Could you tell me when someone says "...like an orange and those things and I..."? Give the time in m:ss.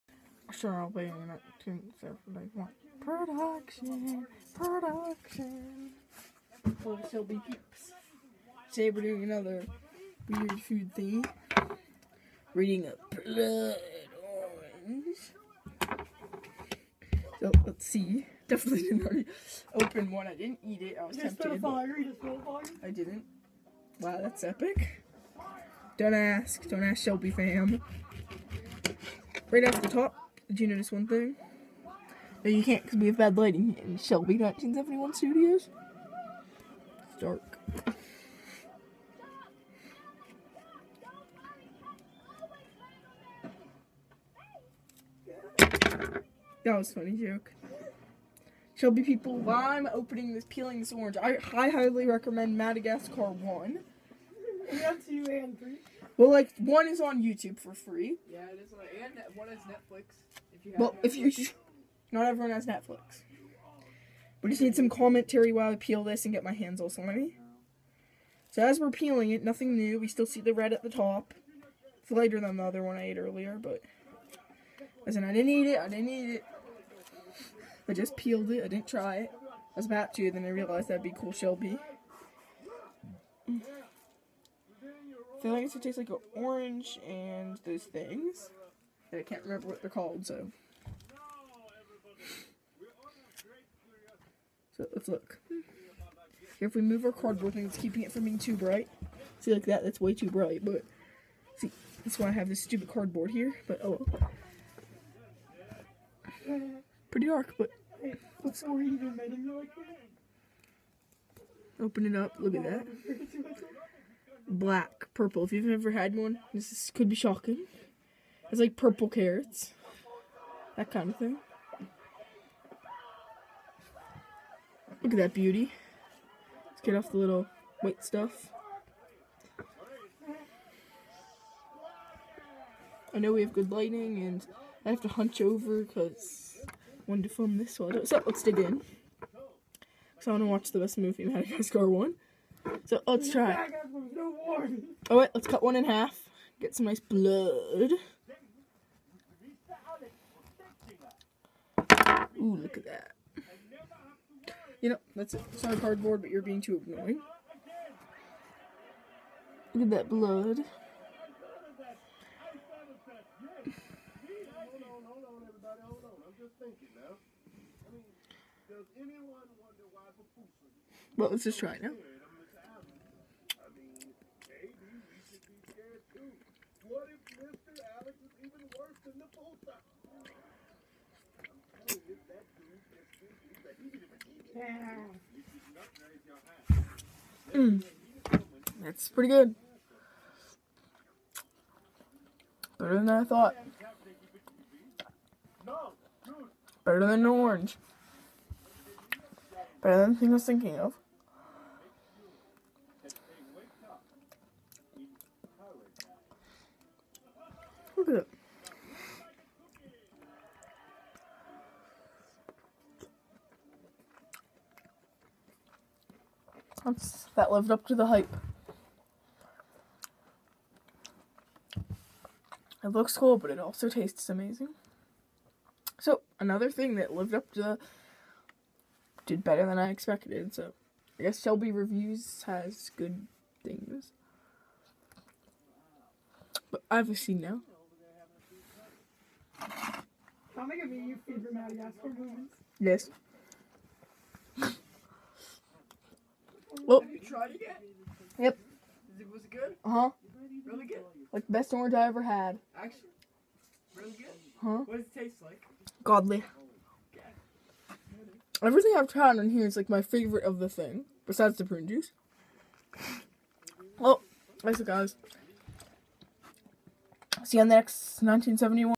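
1:25.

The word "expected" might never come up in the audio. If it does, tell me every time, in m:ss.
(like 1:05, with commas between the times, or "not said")
3:49.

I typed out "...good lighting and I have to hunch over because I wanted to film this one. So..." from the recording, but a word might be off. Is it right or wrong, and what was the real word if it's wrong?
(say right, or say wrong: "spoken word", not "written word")
right.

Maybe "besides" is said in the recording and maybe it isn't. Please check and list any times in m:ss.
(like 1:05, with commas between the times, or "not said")
4:21.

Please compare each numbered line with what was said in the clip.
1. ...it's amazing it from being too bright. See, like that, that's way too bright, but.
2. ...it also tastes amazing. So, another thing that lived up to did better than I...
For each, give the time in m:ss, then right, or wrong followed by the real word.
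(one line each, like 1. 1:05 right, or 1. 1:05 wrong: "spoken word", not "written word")
1. 1:37 wrong: "keeping", not "amazing"
2. 3:43 right.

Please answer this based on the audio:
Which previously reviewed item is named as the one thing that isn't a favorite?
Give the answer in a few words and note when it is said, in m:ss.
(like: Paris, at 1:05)
Prune juice, at 4:21.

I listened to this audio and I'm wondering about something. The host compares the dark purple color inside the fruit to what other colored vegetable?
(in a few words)
Purple carrots.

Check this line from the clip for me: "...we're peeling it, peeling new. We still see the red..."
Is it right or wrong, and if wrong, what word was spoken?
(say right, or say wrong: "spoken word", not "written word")
wrong: "nothing", not "peeling".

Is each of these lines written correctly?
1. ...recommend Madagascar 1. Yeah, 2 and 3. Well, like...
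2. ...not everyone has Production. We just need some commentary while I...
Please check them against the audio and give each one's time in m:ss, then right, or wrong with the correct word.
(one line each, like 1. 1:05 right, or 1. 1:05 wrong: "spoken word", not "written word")
1. 0:52 right
2. 1:02 wrong: "Netflix", not "Production".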